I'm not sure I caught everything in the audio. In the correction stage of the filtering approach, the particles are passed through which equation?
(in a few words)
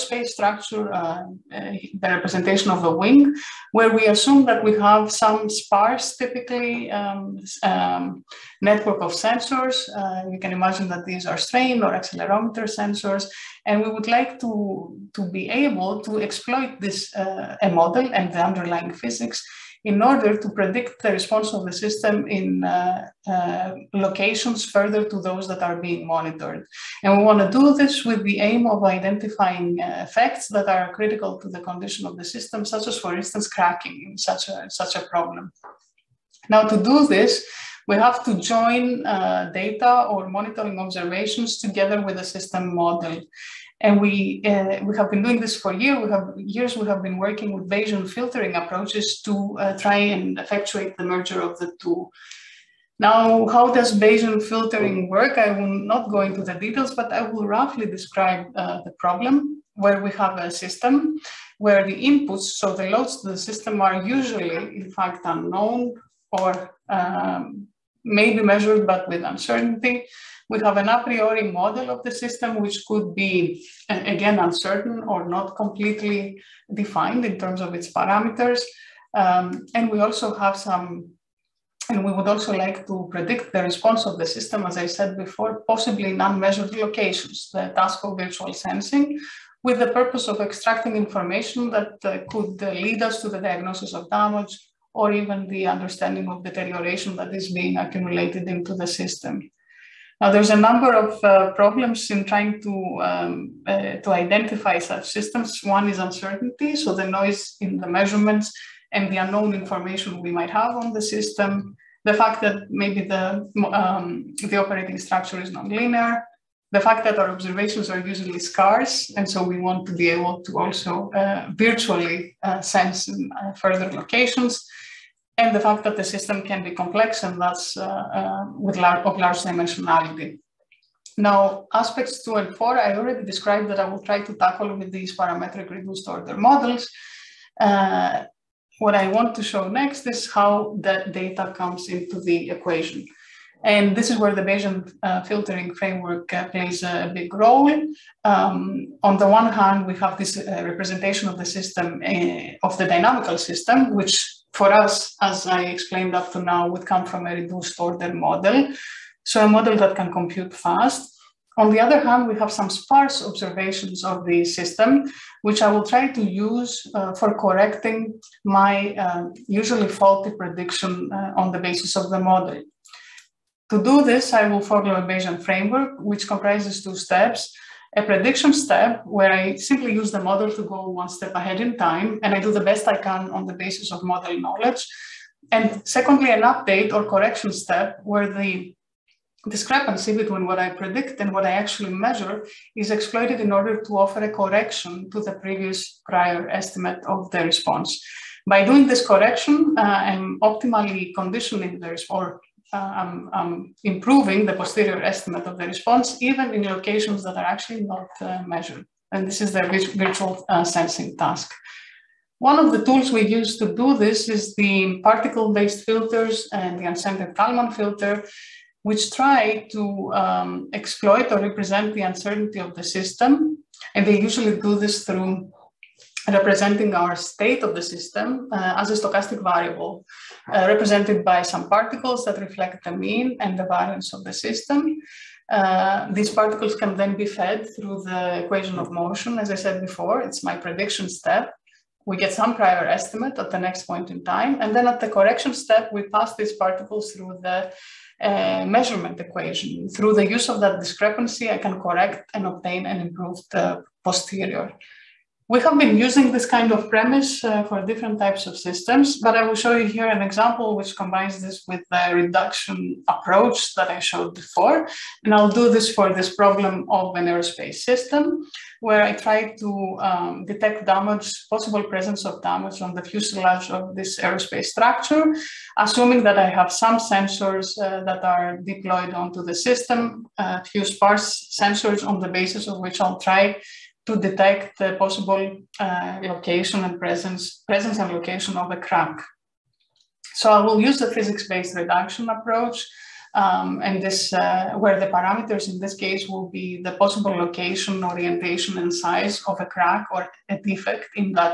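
measurement equation.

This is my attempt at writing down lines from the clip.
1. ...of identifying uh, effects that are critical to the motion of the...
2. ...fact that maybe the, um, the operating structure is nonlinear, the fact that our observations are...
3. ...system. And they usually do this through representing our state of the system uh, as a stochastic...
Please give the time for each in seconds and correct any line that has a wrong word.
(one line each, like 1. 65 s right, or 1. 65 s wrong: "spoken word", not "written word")
1. 28 s wrong: "condition", not "motion"
2. 112 s right
3. 222 s right.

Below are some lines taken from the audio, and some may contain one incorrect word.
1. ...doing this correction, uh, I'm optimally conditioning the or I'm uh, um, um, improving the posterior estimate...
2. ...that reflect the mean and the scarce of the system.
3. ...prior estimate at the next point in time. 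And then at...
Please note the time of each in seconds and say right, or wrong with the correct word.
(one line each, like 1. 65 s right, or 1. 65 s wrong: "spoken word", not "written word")
1. 198 s right
2. 232 s wrong: "variance", not "scarce"
3. 242 s right.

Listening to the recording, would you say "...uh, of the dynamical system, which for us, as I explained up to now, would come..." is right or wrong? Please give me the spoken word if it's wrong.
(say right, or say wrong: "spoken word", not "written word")
right.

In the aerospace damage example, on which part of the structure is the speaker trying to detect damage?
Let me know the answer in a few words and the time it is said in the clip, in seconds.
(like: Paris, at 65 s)
fuselage, at 273 s.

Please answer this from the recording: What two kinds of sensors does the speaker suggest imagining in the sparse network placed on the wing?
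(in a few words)
strain or accelerometer.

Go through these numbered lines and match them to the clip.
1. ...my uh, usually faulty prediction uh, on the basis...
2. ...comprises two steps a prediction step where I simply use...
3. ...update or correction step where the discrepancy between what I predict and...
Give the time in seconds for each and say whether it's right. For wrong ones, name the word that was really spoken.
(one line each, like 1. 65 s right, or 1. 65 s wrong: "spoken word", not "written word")
1. 168 s right
2. 176 s right
3. 186 s right.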